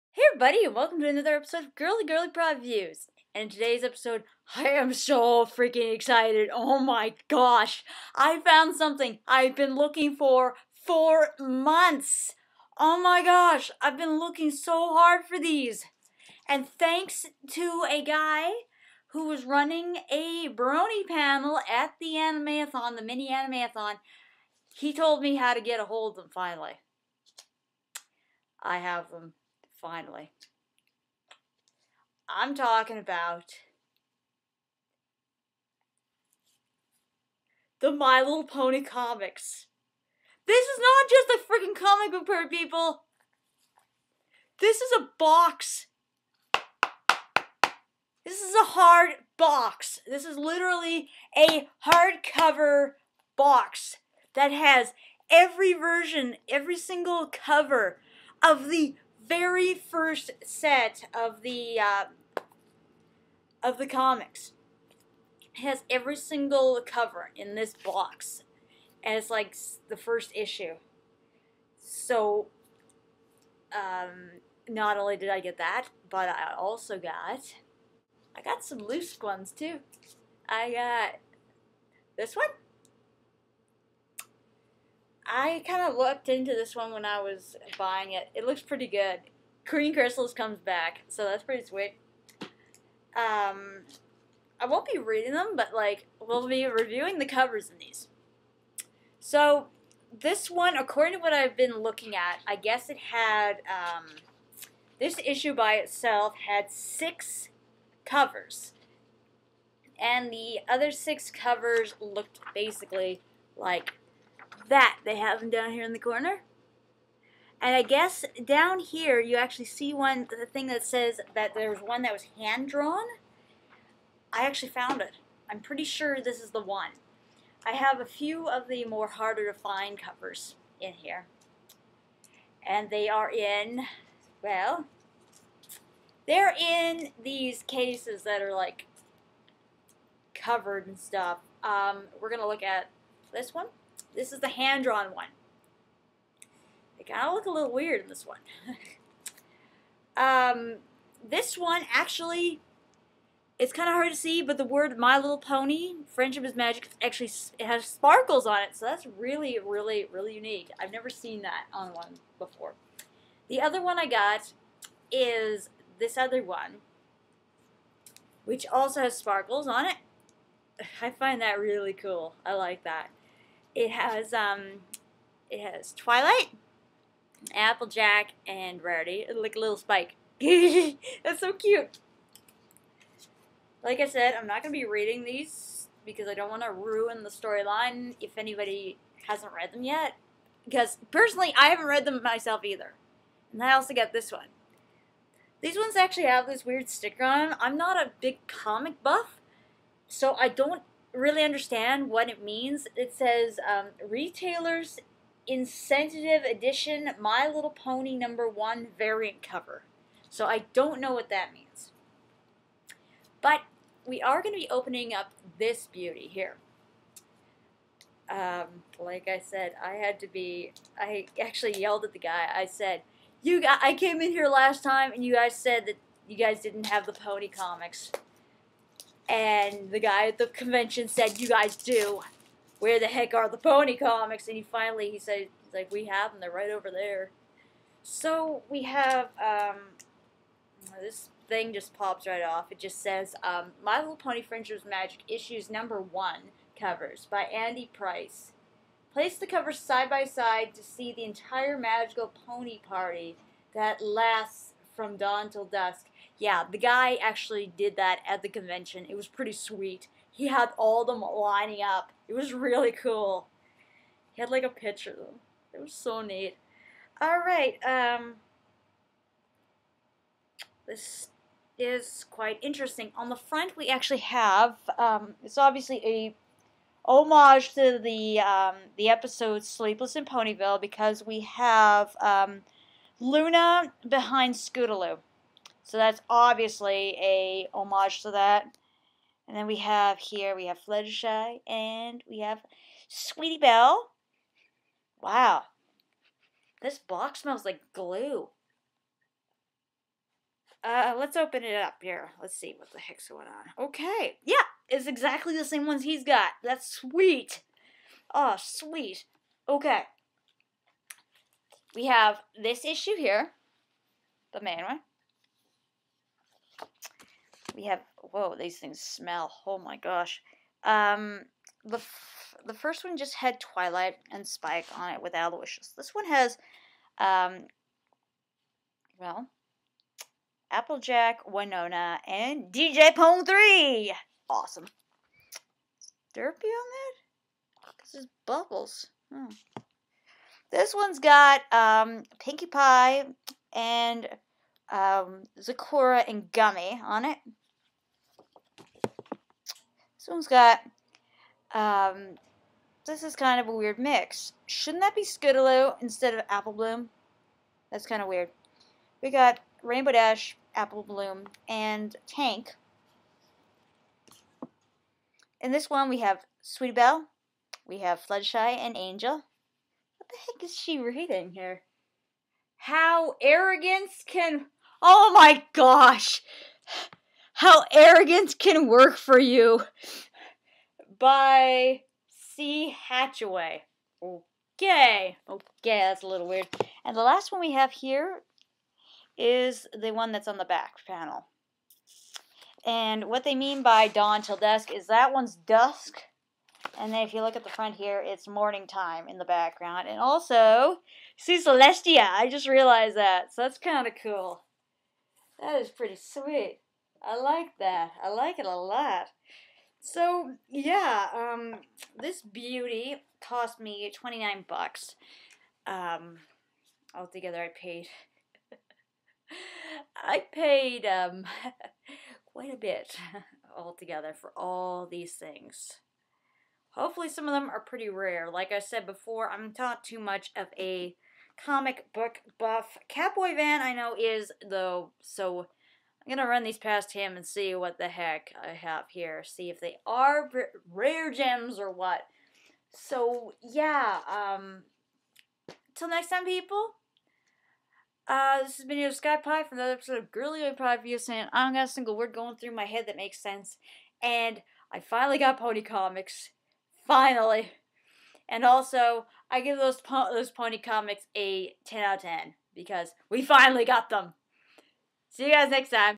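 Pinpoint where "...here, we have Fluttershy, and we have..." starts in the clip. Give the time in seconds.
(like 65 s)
290 s.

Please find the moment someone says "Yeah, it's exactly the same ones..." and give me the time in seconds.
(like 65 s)
304 s.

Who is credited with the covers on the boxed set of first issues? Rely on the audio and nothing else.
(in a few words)
Andy Price.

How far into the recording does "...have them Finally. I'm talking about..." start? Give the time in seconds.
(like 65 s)
28 s.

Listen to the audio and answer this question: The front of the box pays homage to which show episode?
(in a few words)
Sleepless in Ponyville.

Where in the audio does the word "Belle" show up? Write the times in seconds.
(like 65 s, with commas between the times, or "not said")
293 s, 366 s.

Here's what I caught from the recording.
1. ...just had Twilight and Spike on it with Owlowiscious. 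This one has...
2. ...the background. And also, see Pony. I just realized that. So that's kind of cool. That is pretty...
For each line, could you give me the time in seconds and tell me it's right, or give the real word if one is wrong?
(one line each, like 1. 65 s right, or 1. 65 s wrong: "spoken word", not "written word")
1. 323 s right
2. 399 s wrong: "Celestia", not "Pony".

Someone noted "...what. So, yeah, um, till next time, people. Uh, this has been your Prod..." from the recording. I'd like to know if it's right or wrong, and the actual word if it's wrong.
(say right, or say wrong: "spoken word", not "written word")
wrong: "Sky", not "Prod".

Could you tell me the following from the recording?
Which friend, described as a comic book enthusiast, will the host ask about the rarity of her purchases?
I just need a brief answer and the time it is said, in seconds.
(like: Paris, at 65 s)
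Catboy Van, at 433 s.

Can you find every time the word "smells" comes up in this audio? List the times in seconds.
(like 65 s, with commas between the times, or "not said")
297 s, 318 s.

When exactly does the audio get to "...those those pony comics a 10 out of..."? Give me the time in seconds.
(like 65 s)
459 s.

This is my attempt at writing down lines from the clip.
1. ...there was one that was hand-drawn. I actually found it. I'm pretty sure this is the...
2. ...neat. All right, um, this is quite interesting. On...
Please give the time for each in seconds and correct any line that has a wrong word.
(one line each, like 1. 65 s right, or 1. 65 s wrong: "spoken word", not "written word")
1. 121 s right
2. 266 s right.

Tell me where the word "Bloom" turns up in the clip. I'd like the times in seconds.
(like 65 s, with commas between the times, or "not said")
356 s, 361 s.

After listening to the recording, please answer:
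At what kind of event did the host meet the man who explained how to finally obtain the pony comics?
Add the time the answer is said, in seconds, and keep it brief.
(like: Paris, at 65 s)
Mini Animeathon, at 22 s.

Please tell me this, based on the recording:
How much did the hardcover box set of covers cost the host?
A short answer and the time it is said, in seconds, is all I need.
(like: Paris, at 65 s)
$29, at 414 s.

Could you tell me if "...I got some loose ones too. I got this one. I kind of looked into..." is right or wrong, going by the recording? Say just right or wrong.
right.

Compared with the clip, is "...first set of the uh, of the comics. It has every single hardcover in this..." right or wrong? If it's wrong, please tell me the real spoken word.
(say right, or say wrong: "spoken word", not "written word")
wrong: "cover", not "hardcover".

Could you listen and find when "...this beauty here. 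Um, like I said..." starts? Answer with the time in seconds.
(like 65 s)
215 s.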